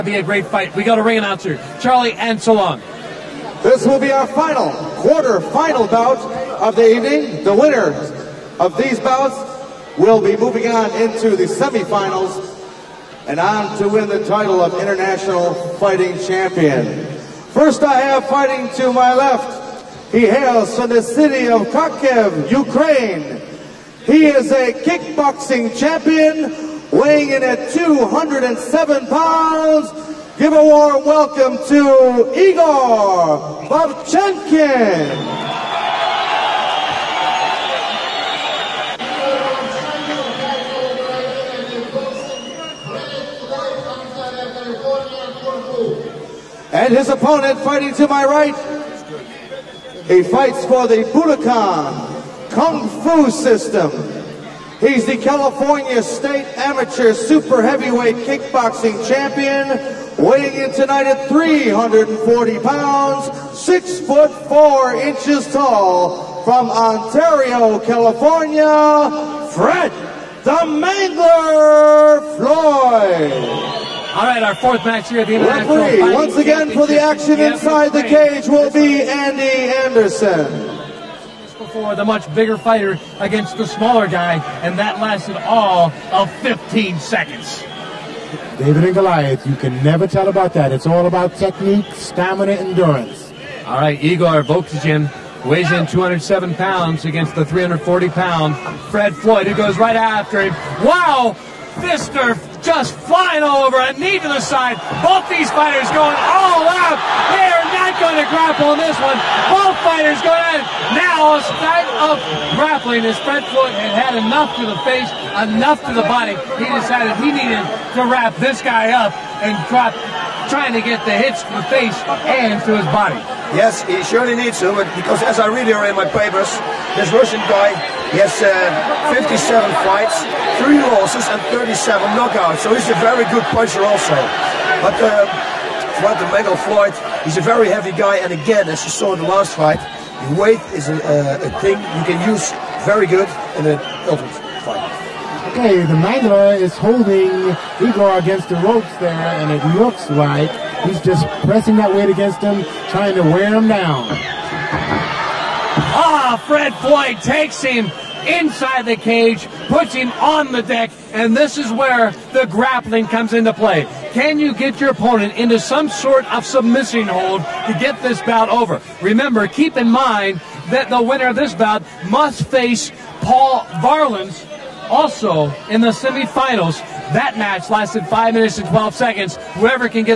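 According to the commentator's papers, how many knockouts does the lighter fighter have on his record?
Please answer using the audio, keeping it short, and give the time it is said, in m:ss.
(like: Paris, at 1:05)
37, at 2:11.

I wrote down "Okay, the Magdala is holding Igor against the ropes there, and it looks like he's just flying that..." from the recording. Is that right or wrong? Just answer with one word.
wrong.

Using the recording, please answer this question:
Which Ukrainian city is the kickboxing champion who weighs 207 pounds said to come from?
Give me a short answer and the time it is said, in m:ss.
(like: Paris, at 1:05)
Kharkiv, at 0:21.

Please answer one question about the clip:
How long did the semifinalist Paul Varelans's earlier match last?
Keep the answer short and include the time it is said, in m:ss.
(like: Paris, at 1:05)
5 minutes and 12 seconds, at 2:58.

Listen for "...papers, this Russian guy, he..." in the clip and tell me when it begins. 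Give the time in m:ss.
2:06.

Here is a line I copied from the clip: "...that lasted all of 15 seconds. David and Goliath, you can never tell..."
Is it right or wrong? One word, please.
right.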